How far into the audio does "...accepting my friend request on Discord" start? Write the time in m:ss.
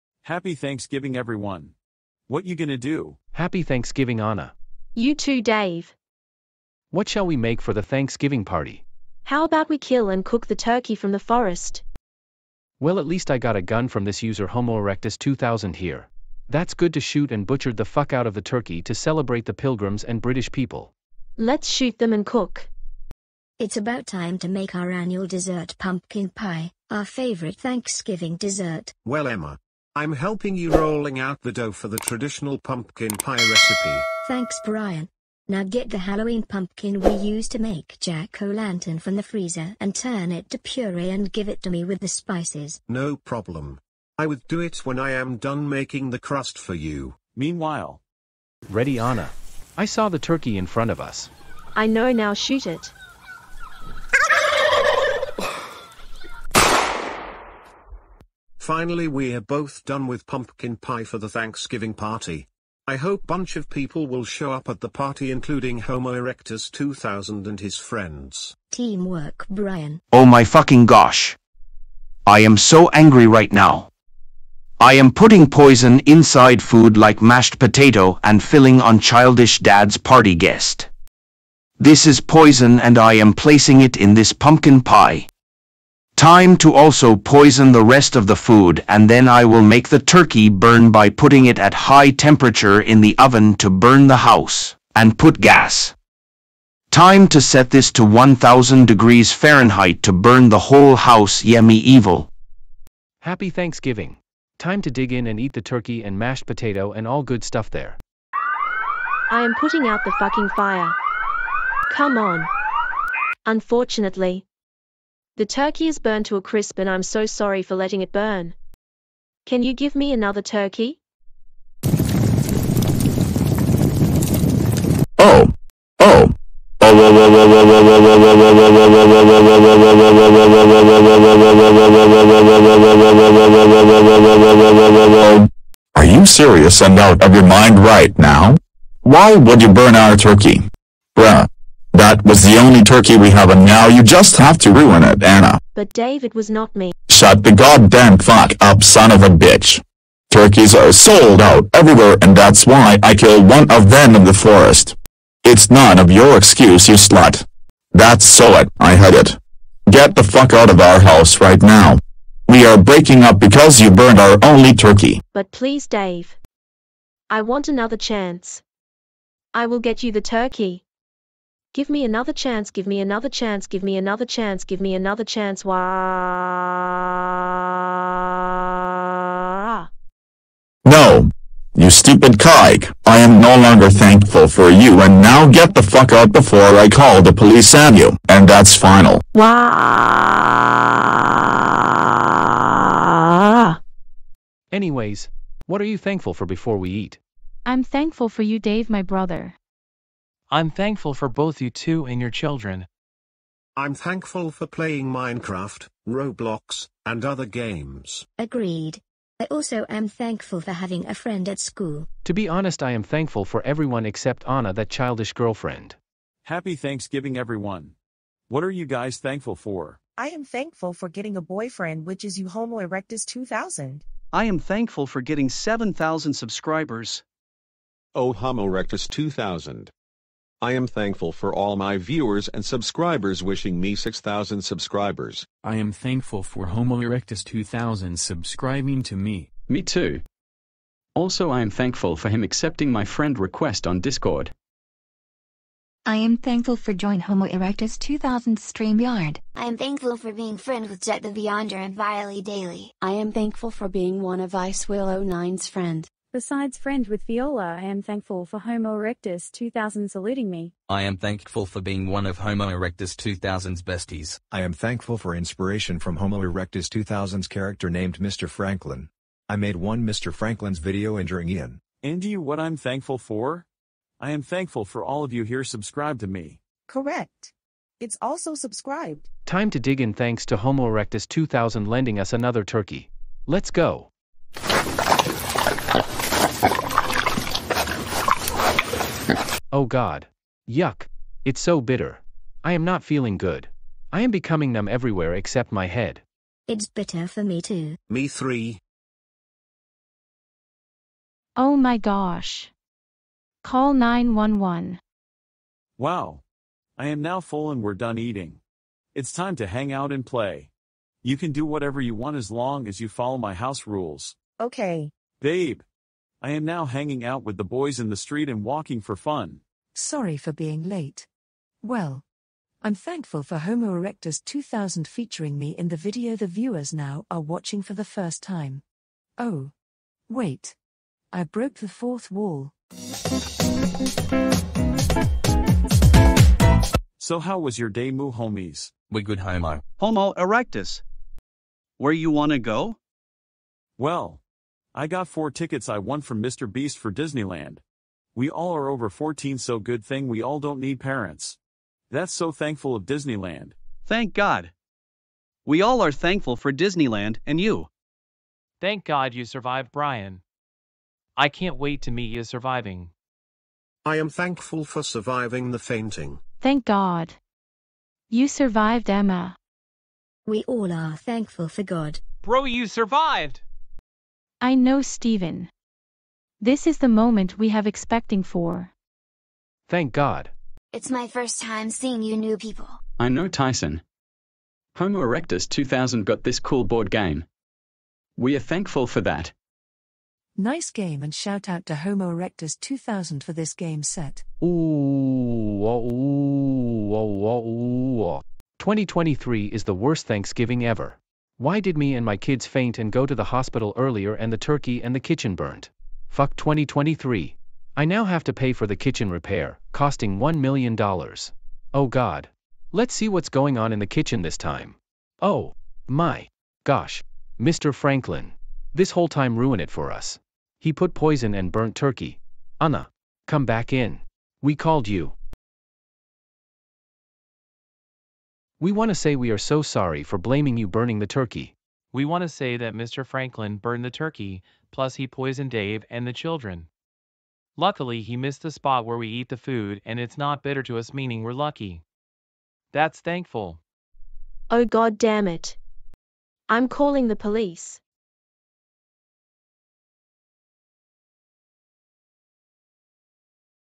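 4:02.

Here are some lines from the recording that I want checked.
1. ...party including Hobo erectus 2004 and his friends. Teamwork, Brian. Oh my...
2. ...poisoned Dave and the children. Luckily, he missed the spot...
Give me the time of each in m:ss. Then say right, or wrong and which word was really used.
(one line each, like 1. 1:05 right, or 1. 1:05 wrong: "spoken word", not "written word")
1. 1:04 wrong: "2000", not "2004"
2. 7:15 right.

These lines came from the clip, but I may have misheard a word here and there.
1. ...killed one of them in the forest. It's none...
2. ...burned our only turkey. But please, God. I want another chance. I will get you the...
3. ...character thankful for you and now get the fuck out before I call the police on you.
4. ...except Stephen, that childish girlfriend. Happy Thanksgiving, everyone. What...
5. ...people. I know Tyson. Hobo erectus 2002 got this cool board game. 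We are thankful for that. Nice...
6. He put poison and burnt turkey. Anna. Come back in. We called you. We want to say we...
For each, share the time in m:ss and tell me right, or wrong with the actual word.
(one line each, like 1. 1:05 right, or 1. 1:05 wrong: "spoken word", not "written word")
1. 2:33 right
2. 2:43 wrong: "Dave", not "God"
3. 3:03 wrong: "longer", not "character"
4. 3:34 wrong: "Anna", not "Stephen"
5. 6:22 wrong: "2000", not "2002"
6. 7:00 right.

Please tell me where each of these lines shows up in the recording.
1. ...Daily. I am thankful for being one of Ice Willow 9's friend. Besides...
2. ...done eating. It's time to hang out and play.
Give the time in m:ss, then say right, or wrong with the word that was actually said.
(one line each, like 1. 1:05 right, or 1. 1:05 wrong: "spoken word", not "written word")
1. 4:12 right
2. 5:07 right.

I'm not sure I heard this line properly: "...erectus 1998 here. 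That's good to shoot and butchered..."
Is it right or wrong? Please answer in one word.
wrong.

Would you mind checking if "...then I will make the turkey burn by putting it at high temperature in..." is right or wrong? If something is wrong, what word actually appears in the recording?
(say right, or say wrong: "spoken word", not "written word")
right.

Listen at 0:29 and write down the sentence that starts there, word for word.
Well, Emma, I'm helping you rolling out the dough for the traditional pumpkin pie recipe.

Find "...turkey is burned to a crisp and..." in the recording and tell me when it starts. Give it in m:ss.
1:55.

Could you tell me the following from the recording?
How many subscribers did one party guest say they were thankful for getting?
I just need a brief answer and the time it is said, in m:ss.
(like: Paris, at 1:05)
7,000, at 3:45.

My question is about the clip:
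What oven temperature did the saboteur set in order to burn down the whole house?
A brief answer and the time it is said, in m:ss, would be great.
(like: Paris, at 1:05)
1000 degrees Fahrenheit, at 1:38.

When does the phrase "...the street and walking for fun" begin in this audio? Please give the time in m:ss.
5:18.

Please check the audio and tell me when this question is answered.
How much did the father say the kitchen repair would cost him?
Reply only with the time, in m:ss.
6:50.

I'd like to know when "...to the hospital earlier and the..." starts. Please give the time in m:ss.
6:43.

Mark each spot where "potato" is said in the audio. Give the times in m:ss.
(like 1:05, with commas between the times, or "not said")
1:17, 1:46.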